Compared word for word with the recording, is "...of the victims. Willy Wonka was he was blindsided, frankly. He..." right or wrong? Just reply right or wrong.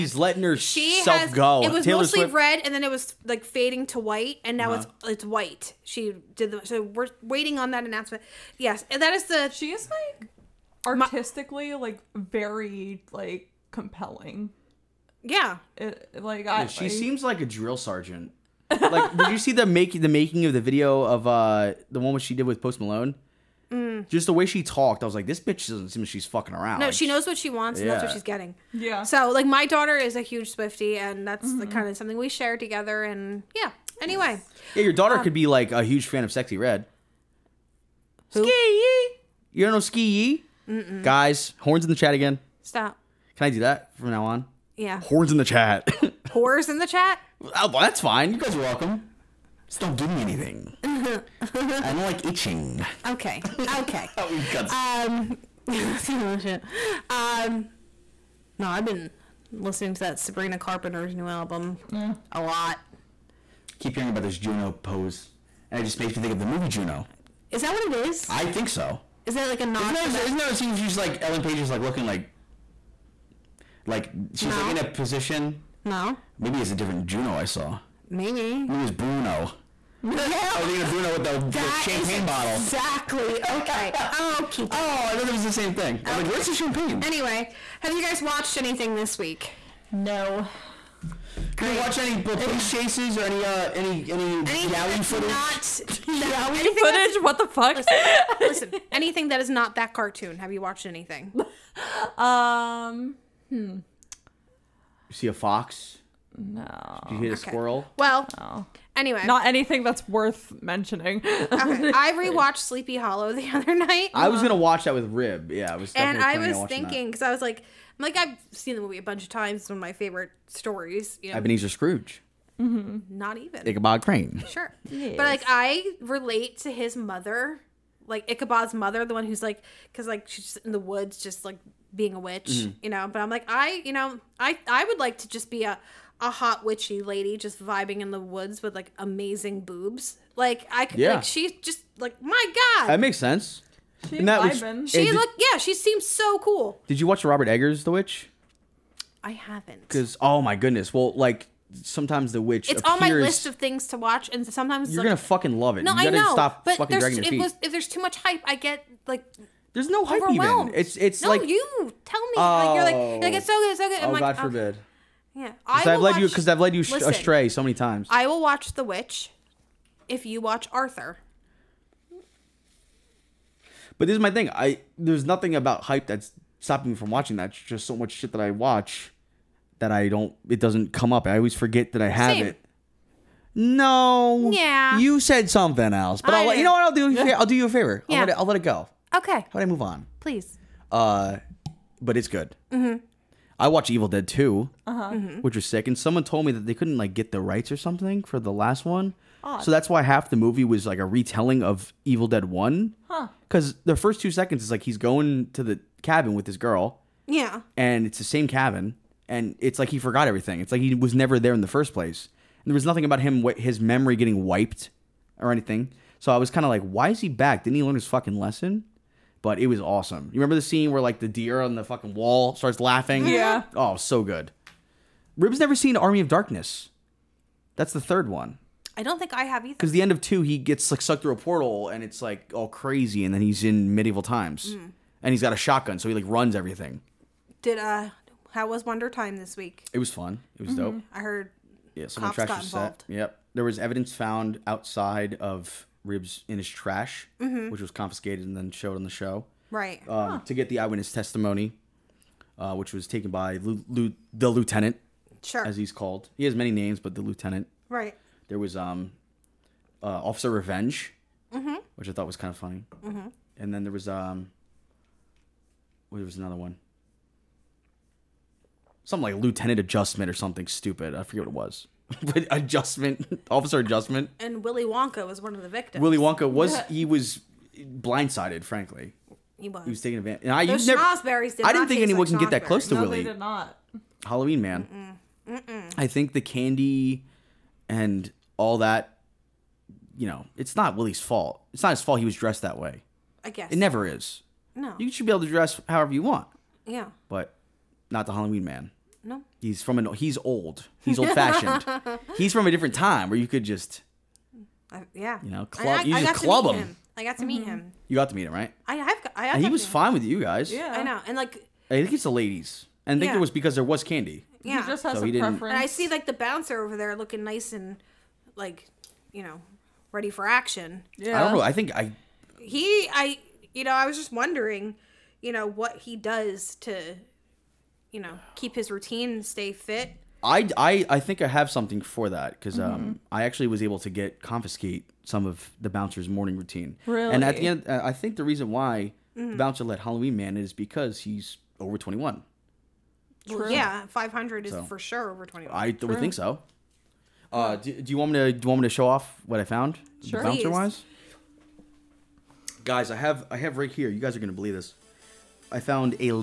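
right.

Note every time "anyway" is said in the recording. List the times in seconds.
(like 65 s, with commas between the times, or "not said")
34 s, 87 s, 108 s.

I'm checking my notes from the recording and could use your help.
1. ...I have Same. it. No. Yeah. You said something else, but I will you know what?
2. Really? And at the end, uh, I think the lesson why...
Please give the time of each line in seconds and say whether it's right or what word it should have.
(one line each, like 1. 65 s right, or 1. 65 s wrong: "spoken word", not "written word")
1. 182 s right
2. 337 s wrong: "reason", not "lesson".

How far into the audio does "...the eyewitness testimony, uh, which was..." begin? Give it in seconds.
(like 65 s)
250 s.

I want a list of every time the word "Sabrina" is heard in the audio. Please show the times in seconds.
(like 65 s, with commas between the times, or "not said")
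60 s.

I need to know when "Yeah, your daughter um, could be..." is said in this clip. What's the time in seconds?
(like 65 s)
34 s.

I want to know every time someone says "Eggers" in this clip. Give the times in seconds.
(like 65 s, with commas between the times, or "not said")
147 s.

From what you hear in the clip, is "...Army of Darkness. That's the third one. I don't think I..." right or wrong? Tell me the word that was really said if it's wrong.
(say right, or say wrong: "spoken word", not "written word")
right.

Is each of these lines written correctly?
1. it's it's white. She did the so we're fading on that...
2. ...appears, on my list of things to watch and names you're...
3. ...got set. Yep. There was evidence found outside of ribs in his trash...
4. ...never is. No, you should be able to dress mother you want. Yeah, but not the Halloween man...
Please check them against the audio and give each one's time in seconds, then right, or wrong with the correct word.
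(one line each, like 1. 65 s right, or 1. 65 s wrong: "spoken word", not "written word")
1. 5 s wrong: "waiting", not "fading"
2. 152 s wrong: "sometimes", not "names"
3. 242 s right
4. 293 s wrong: "however", not "mother".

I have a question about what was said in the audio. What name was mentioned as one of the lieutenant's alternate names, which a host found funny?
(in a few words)
Officer Revenge.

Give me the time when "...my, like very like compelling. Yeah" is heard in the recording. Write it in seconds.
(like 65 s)
11 s.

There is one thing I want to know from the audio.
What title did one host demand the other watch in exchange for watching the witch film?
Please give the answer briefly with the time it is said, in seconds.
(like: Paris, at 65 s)
Arthur, at 170 s.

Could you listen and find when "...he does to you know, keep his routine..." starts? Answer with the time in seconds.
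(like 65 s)
326 s.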